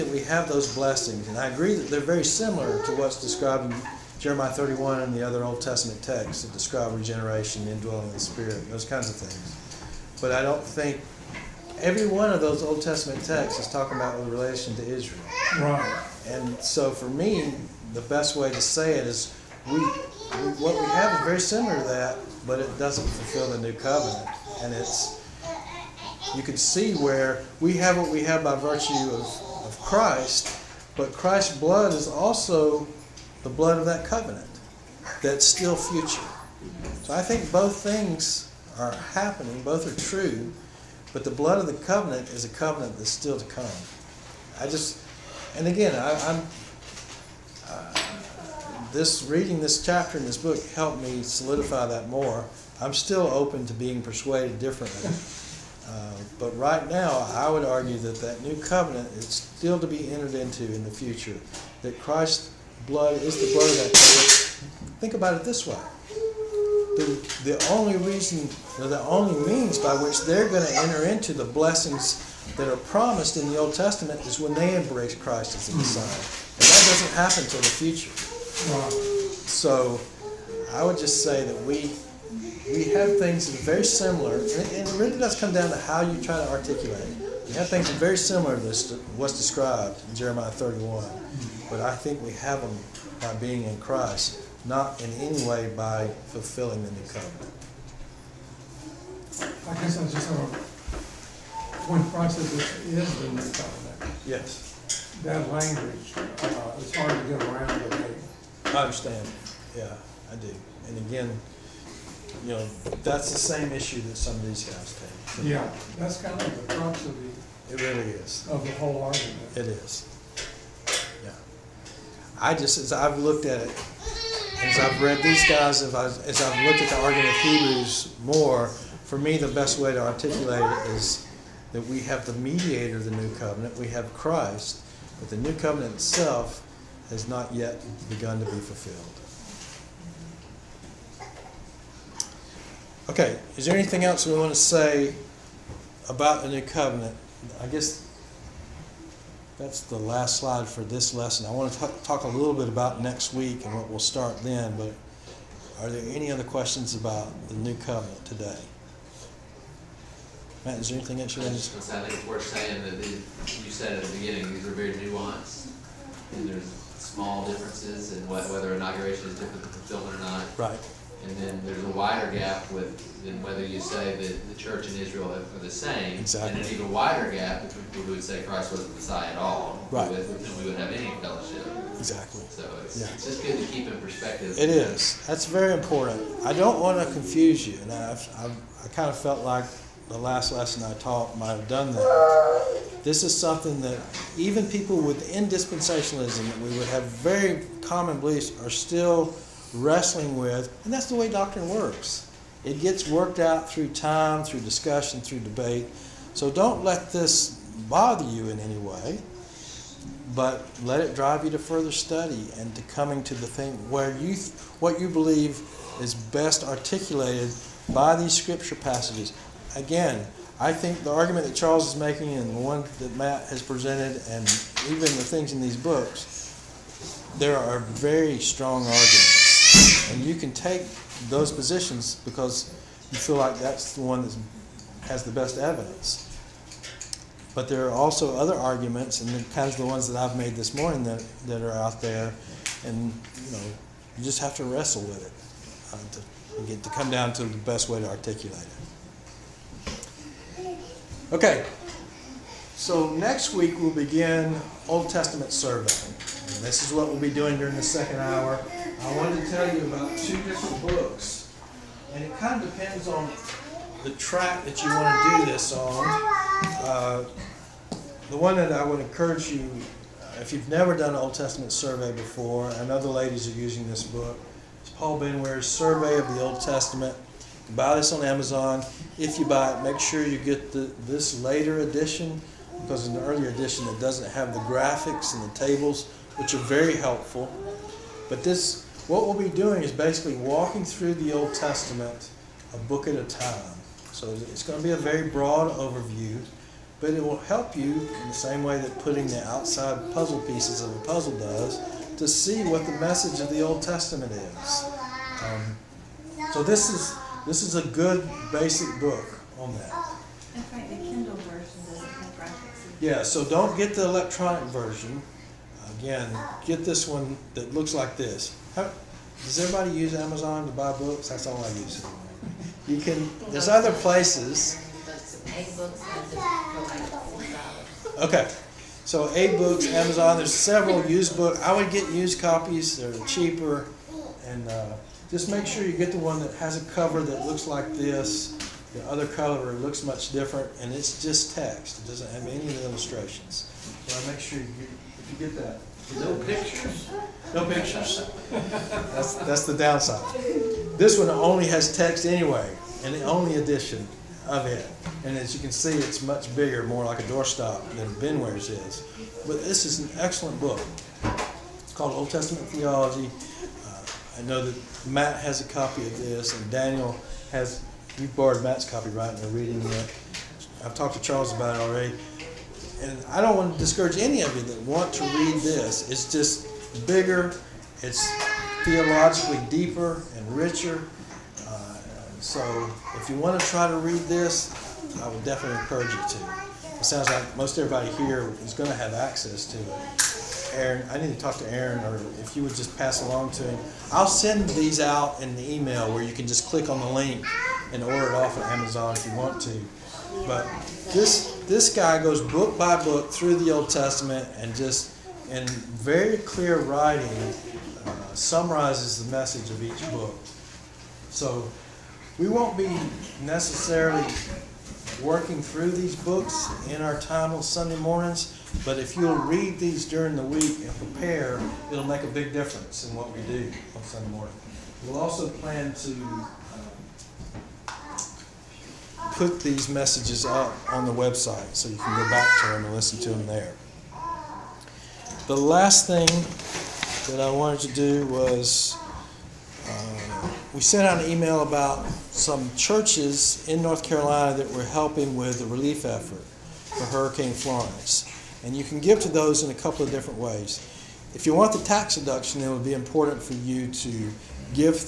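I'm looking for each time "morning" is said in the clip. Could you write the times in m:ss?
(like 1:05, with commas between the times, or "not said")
4:00, 6:57, 7:04.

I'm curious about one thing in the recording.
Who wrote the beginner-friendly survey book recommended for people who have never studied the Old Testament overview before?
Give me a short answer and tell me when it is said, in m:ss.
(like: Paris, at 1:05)
Paul Benware, at 4:34.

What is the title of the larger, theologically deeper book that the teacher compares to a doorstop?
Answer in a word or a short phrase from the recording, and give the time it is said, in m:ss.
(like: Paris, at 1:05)
Old Testament Theology, at 6:02.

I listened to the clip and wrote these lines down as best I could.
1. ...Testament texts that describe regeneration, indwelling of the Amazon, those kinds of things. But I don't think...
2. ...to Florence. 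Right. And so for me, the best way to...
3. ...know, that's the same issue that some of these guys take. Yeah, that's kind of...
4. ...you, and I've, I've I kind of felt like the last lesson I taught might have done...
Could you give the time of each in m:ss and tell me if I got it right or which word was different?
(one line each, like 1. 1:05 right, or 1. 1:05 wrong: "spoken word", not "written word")
1. 0:05 wrong: "Spirit", not "Amazon"
2. 0:14 wrong: "Israel", not "Florence"
3. 1:52 right
4. 3:07 right.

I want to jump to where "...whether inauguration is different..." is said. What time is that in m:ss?
2:48.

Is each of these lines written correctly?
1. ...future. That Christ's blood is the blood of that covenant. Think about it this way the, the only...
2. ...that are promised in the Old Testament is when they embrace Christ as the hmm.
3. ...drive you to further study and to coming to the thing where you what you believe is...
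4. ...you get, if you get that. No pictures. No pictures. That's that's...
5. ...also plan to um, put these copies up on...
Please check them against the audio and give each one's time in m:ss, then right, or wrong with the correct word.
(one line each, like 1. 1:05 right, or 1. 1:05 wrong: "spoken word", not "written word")
1. 1:00 right
2. 1:12 right
3. 3:31 right
4. 5:44 right
5. 7:05 wrong: "messages", not "copies".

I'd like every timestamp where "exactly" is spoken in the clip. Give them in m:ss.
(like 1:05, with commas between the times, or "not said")
2:56, 3:01.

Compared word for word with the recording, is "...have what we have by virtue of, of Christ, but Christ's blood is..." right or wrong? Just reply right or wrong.
right.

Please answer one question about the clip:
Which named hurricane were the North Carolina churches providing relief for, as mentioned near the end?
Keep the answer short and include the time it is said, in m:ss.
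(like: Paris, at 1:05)
Hurricane Florence, at 7:27.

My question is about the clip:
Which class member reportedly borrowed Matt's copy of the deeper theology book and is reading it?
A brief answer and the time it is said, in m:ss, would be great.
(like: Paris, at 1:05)
Daniel, at 6:06.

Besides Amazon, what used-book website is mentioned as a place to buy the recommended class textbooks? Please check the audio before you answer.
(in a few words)
AbeBooks.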